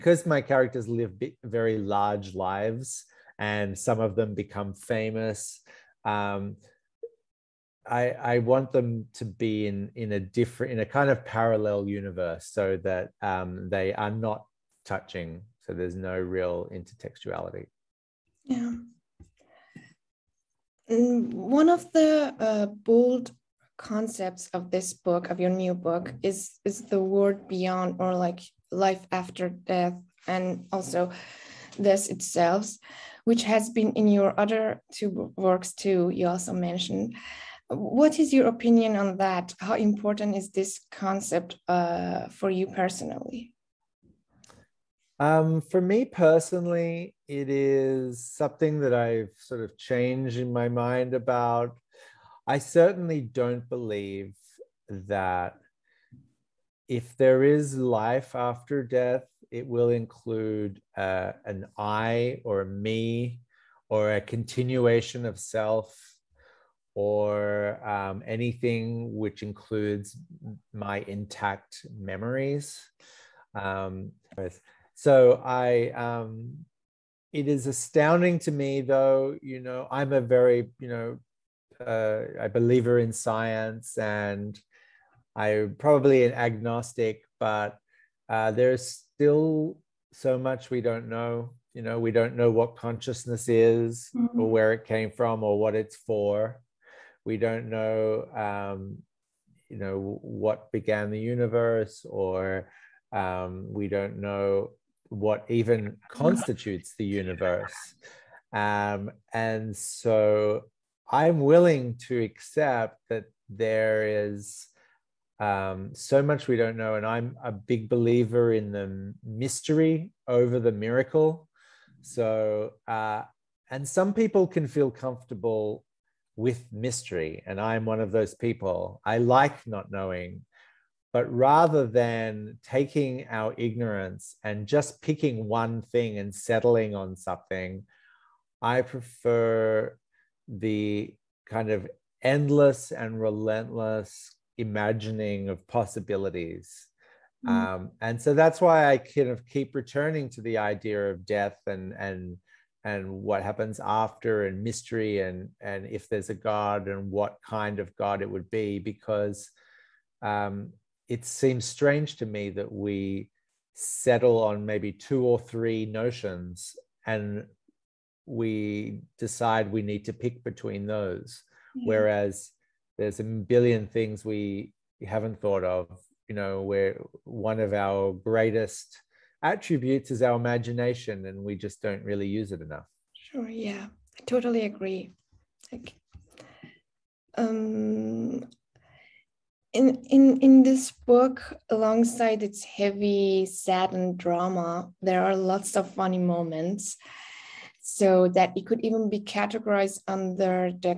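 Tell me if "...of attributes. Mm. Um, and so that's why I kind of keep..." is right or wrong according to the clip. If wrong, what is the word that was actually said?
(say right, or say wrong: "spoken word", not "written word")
wrong: "possibilities", not "attributes".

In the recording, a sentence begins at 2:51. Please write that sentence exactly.
Whereas there's a billion things we haven't thought of.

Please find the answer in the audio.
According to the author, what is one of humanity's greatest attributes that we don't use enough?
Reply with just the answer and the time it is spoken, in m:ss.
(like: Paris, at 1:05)
imagination, at 3:00.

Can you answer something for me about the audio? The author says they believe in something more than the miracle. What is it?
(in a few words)
the mystery.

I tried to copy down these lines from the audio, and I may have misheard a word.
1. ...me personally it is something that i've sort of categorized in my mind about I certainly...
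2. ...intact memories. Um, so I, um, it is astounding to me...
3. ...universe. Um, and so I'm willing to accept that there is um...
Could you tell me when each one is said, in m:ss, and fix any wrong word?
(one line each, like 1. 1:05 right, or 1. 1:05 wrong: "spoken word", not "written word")
1. 0:45 wrong: "changed", not "categorized"
2. 1:11 right
3. 1:47 right.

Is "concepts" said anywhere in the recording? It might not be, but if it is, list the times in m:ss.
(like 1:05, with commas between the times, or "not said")
0:23, 0:40.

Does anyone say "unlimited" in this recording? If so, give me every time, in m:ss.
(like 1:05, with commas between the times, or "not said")
not said.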